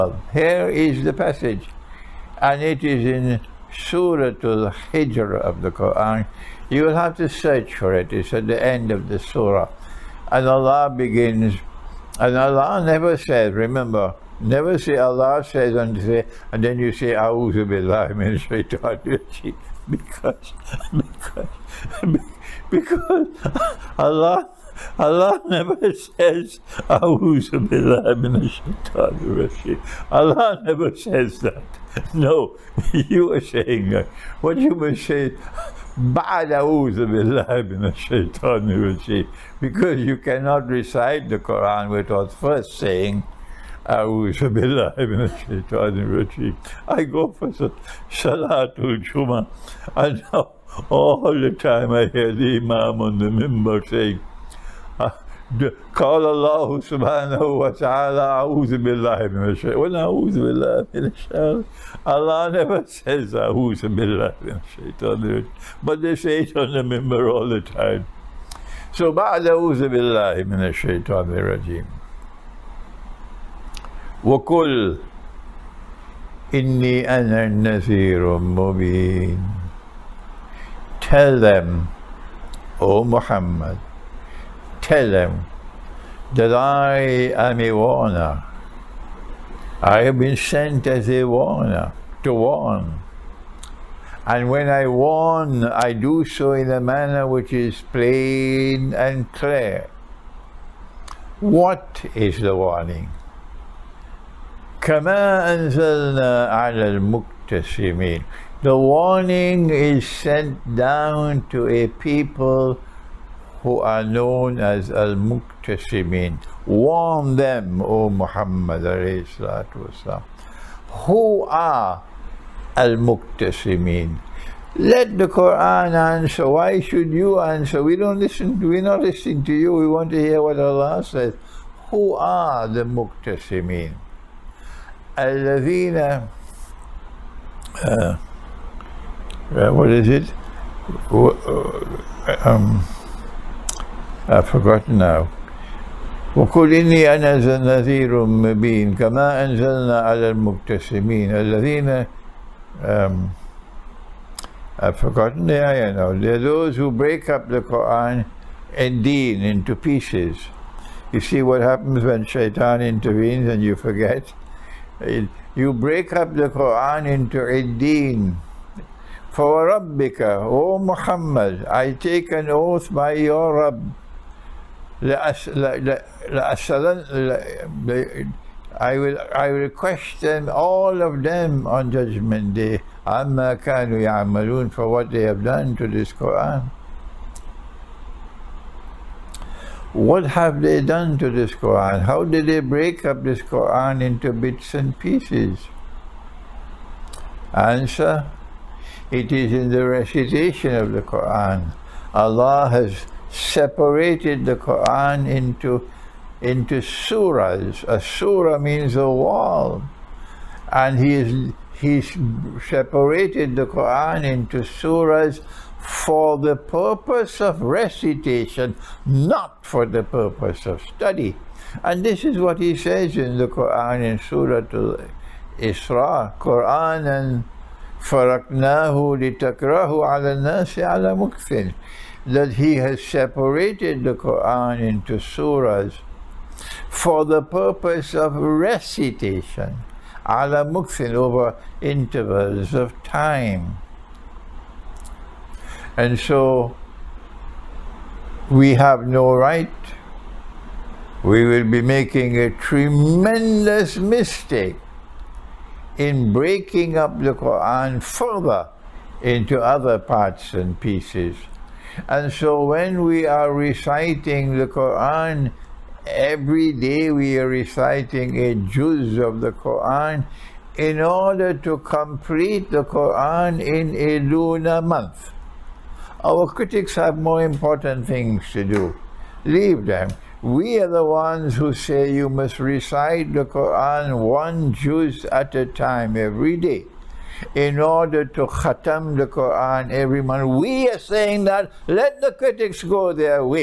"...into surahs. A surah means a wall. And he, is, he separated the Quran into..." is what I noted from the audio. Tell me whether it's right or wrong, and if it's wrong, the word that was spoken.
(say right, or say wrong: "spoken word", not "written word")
right.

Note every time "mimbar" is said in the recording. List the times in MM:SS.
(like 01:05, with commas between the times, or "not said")
00:53, 01:06.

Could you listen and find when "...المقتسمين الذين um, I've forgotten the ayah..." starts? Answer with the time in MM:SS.
02:30.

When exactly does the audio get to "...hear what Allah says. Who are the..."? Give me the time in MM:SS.
02:10.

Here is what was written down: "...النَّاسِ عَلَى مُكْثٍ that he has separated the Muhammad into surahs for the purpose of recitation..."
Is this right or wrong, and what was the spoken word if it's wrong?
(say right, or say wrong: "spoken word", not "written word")
wrong: "Quran", not "Muhammad".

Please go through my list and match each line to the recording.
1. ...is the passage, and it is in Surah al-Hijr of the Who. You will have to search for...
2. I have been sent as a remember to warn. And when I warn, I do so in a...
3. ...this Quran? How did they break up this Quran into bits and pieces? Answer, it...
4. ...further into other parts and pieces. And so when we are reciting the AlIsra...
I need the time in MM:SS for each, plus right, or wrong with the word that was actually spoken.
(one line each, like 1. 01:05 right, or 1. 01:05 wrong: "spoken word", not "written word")
1. 00:00 wrong: "Quran", not "Who"
2. 01:29 wrong: "warner", not "remember"
3. 03:11 right
4. 04:18 wrong: "Quran", not "AlIsra".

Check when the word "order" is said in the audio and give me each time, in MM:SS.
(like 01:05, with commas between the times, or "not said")
04:30, 04:47.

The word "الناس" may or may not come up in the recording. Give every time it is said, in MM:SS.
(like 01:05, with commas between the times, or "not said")
03:50.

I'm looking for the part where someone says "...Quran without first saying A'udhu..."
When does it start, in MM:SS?
00:41.